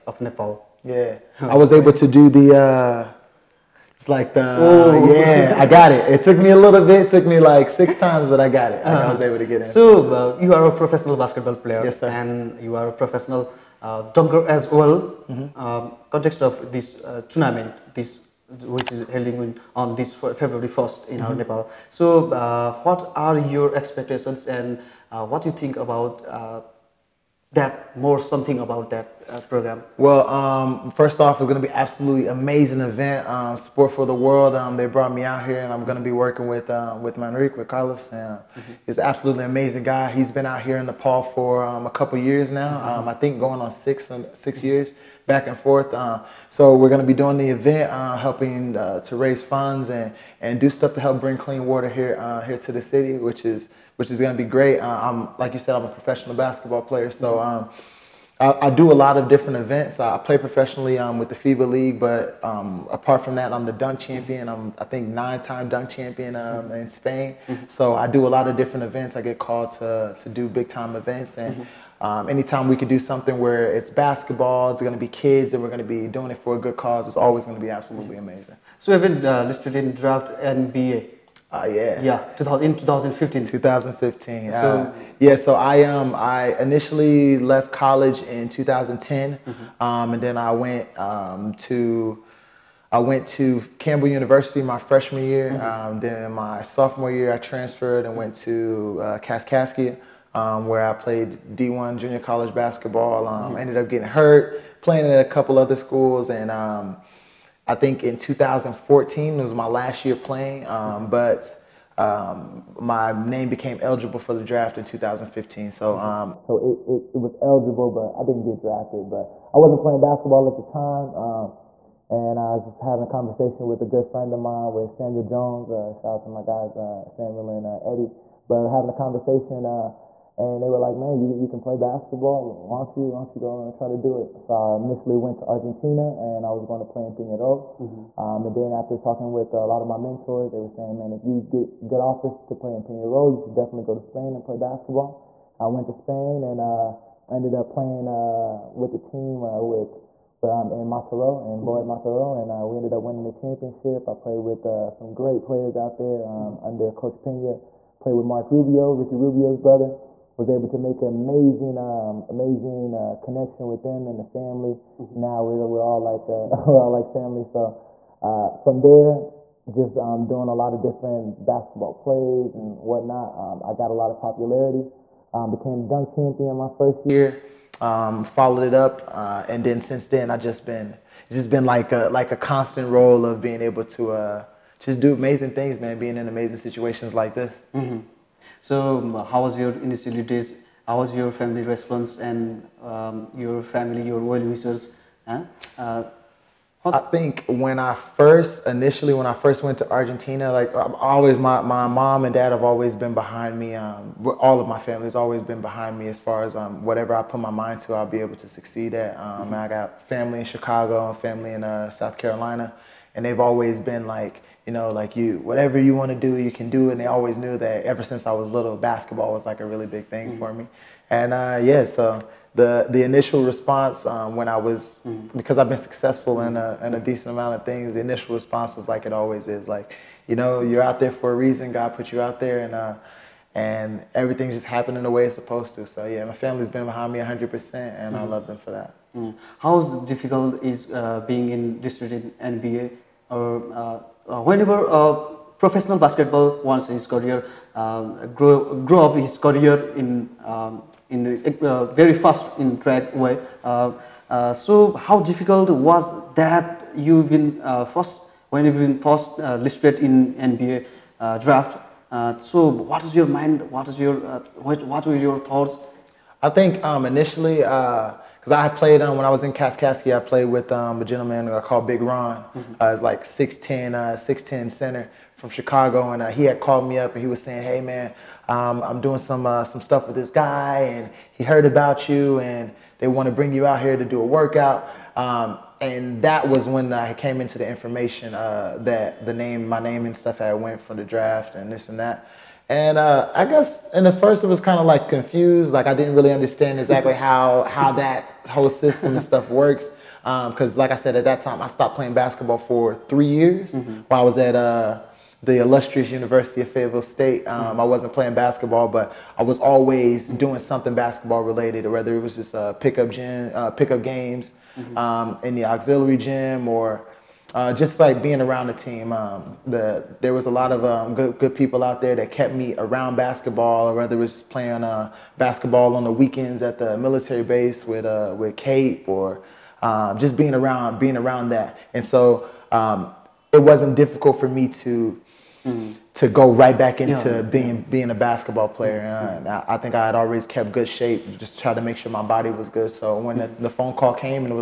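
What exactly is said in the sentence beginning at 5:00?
Because, um, like I said, at that time, I stopped playing basketball for three years mm-hmm.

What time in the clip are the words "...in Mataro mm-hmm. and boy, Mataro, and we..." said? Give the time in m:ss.
2:30.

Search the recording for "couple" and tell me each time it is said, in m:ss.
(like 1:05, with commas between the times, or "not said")
0:41, 1:45.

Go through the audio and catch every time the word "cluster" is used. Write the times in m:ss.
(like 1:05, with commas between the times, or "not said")
not said.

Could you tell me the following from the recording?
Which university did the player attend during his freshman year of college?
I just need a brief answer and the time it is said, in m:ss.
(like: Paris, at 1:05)
Campbell University, at 1:33.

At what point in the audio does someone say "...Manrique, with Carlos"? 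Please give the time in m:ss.
0:37.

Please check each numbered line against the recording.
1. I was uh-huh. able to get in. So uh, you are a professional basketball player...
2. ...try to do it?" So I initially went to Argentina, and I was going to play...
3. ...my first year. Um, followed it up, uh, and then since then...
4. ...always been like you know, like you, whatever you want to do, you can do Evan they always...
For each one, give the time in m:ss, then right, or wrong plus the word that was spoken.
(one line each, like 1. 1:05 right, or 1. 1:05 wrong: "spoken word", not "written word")
1. 0:08 right
2. 2:13 right
3. 2:56 right
4. 3:33 wrong: "And", not "Evan".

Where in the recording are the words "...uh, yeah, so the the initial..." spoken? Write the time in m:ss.
3:41.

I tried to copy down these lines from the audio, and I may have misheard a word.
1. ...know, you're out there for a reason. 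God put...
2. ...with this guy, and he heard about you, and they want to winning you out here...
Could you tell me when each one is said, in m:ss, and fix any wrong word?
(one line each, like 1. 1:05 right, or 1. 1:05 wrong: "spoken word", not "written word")
1. 3:50 right
2. 4:40 wrong: "bring", not "winning".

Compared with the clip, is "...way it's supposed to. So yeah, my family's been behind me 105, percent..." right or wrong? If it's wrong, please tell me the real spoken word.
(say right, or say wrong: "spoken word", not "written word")
wrong: "100", not "105".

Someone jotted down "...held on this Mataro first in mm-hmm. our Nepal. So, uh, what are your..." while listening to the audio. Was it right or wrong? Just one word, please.
wrong.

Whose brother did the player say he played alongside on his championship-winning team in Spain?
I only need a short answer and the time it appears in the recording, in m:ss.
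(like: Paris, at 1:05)
Ricky Rubio, at 2:38.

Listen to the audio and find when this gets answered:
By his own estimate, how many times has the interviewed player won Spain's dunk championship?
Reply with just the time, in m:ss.
1:05.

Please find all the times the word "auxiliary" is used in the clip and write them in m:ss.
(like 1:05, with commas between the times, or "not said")
5:15.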